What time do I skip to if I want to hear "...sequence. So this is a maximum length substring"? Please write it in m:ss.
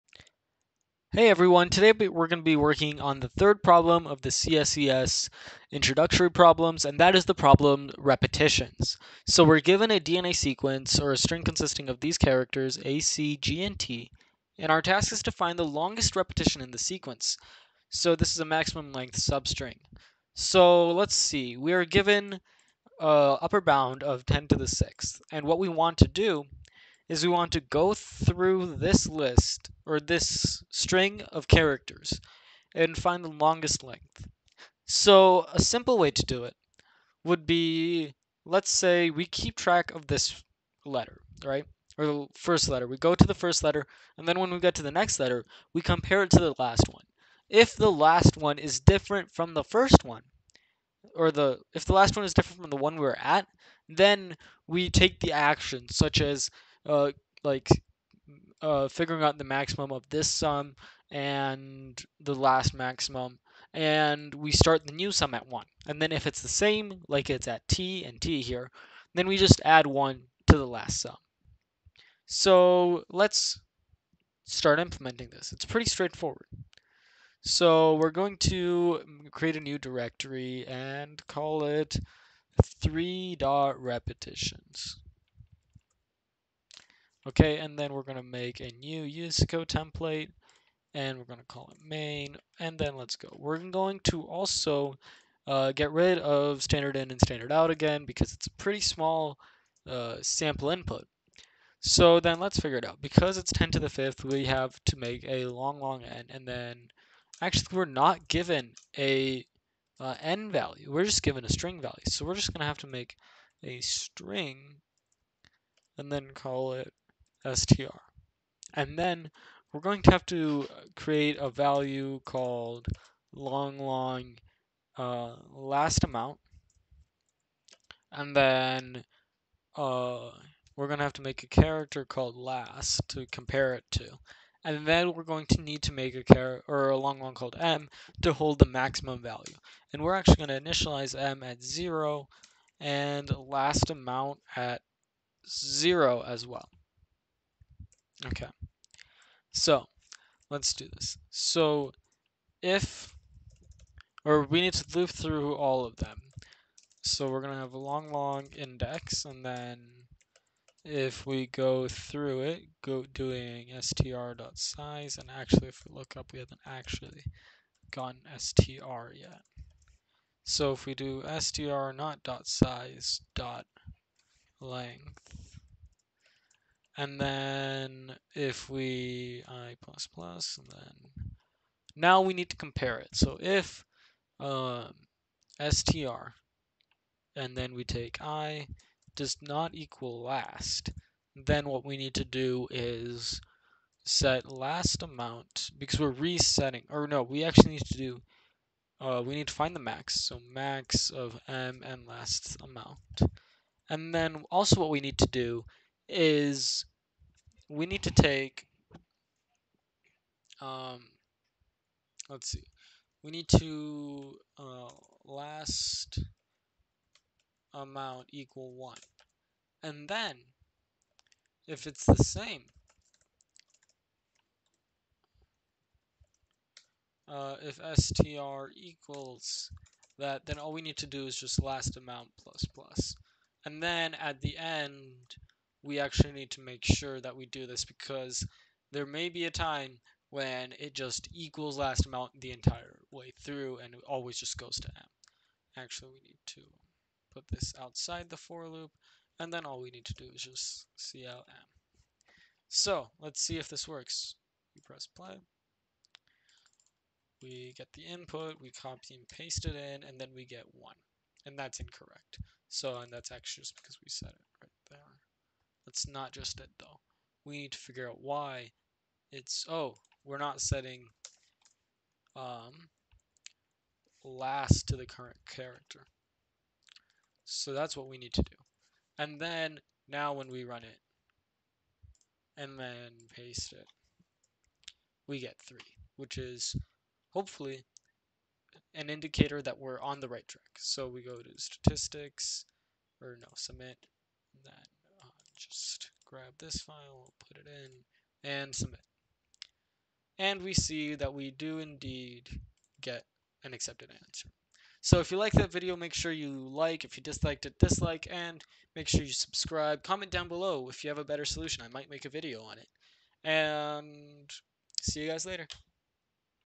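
0:16.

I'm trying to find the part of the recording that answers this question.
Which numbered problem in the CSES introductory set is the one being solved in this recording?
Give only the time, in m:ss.
0:03.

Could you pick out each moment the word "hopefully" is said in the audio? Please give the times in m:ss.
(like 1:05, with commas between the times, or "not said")
4:47.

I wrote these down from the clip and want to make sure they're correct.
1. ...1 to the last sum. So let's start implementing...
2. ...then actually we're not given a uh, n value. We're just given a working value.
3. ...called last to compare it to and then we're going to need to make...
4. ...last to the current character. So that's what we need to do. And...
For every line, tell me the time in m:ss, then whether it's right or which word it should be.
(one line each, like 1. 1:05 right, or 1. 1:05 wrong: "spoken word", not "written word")
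1. 1:09 right
2. 1:46 wrong: "string", not "working"
3. 2:12 right
4. 4:34 right.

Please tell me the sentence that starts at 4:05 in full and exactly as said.
Actually, we need to put this outside the for loop and then all we need to do is just CLM.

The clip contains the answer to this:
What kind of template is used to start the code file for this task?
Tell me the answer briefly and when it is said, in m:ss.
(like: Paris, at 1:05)
USACO template, at 1:29.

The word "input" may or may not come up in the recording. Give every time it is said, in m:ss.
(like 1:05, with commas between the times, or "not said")
1:40, 4:18.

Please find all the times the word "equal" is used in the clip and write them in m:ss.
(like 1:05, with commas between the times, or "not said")
3:09, 3:38, 3:48, 4:01.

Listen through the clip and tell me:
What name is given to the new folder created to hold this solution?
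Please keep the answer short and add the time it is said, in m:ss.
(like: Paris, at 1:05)
3.repetitions, at 1:22.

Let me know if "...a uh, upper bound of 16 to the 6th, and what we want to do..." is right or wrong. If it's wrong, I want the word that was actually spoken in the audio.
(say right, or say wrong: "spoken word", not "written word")
wrong: "10", not "16".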